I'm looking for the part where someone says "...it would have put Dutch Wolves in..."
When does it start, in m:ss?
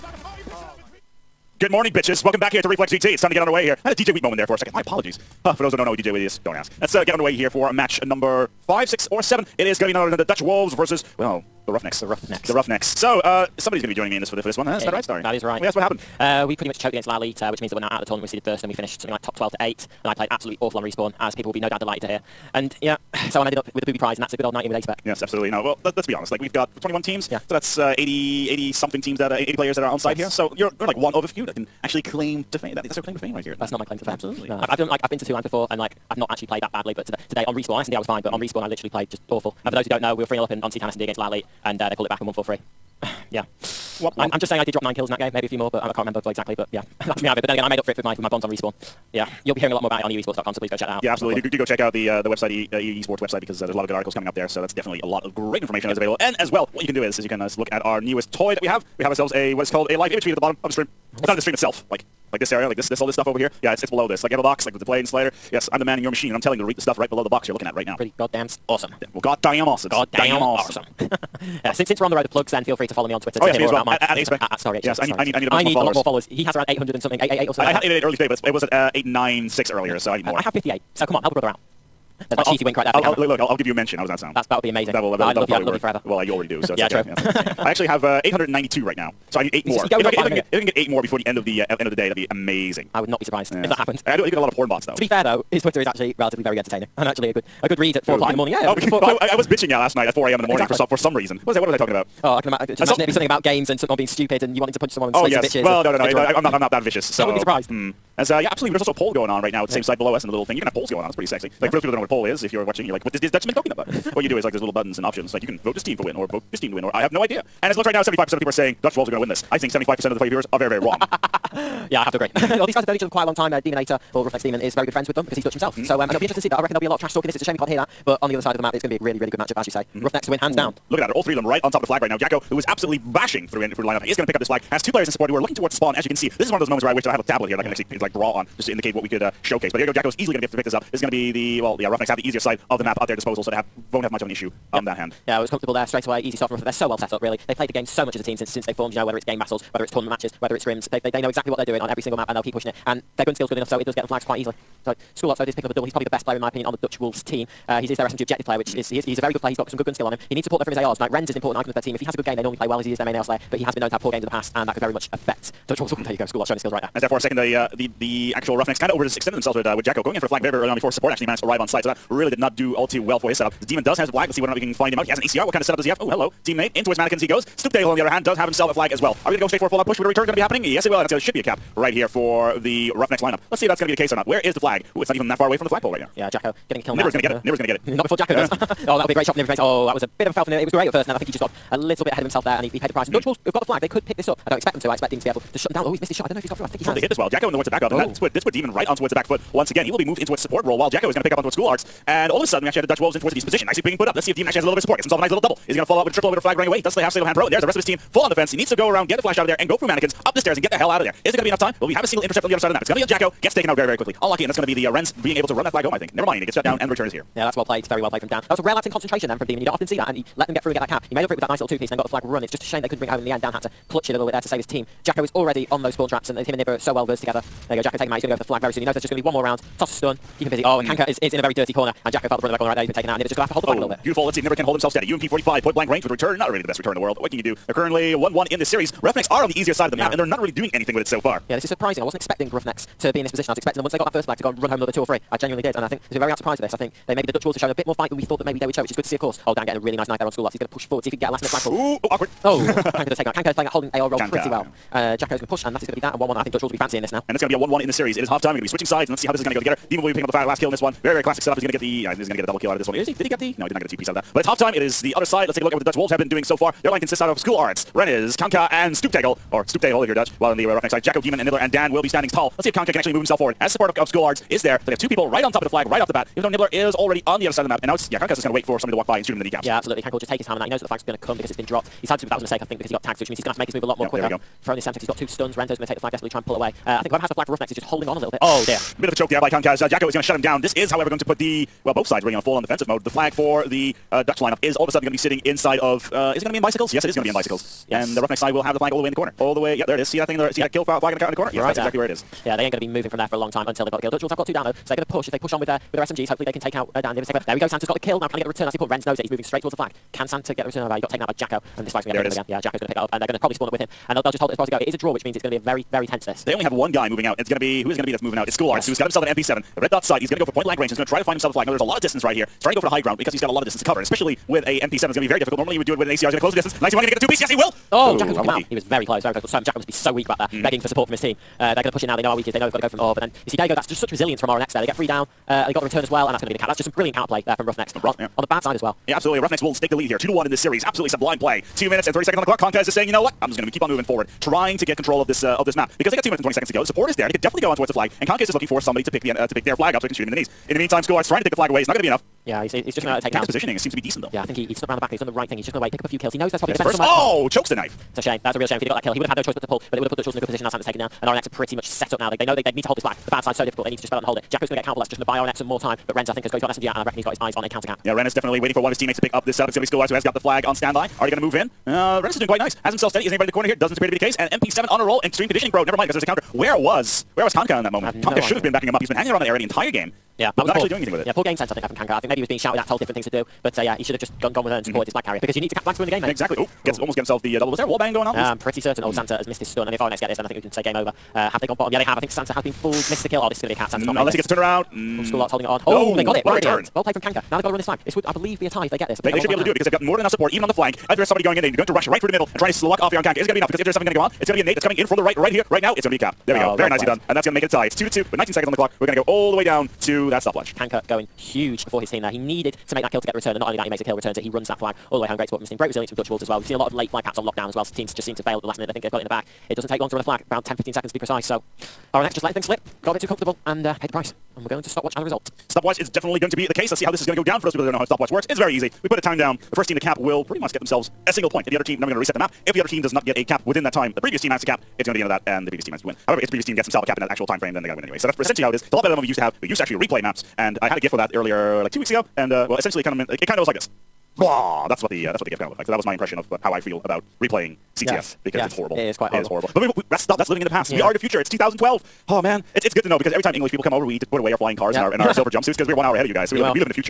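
5:59.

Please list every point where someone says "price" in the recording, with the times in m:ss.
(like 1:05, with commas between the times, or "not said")
3:12, 7:04.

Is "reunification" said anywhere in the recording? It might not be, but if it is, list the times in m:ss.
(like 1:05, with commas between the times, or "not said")
not said.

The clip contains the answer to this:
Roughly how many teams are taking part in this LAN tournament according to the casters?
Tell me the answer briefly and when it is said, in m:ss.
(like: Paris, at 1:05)
21, at 0:26.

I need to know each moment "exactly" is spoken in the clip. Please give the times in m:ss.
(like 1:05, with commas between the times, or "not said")
0:46, 1:40, 2:31, 5:01, 6:26.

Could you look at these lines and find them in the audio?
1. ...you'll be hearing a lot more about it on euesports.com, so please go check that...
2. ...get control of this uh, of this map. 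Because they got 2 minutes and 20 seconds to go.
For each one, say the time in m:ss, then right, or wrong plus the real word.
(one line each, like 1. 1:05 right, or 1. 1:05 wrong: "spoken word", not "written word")
1. 0:49 right
2. 5:44 right.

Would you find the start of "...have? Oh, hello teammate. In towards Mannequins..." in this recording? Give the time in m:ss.
2:55.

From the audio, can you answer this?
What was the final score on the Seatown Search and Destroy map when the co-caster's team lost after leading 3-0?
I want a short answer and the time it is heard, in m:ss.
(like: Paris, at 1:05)
4-3, at 0:42.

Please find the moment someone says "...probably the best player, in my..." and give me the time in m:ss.
2:35.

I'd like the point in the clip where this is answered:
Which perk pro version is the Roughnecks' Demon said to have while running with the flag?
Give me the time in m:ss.
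3:27.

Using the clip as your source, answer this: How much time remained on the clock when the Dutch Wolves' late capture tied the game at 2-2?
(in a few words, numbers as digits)
19 seconds.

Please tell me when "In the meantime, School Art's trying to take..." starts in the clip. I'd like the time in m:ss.
5:50.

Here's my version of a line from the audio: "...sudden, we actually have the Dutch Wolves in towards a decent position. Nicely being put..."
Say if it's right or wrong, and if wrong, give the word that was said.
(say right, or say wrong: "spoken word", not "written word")
right.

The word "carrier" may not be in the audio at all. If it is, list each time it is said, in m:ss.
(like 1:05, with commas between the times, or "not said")
6:25.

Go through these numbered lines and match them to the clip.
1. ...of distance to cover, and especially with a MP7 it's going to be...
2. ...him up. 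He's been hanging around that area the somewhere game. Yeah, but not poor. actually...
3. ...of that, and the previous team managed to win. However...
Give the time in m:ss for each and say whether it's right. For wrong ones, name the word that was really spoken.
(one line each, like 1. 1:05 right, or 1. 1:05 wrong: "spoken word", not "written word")
1. 5:23 right
2. 6:18 wrong: "entire", not "somewhere"
3. 7:15 right.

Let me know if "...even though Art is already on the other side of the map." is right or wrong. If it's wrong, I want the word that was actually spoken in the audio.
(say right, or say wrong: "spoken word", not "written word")
wrong: "Nibbler", not "Art".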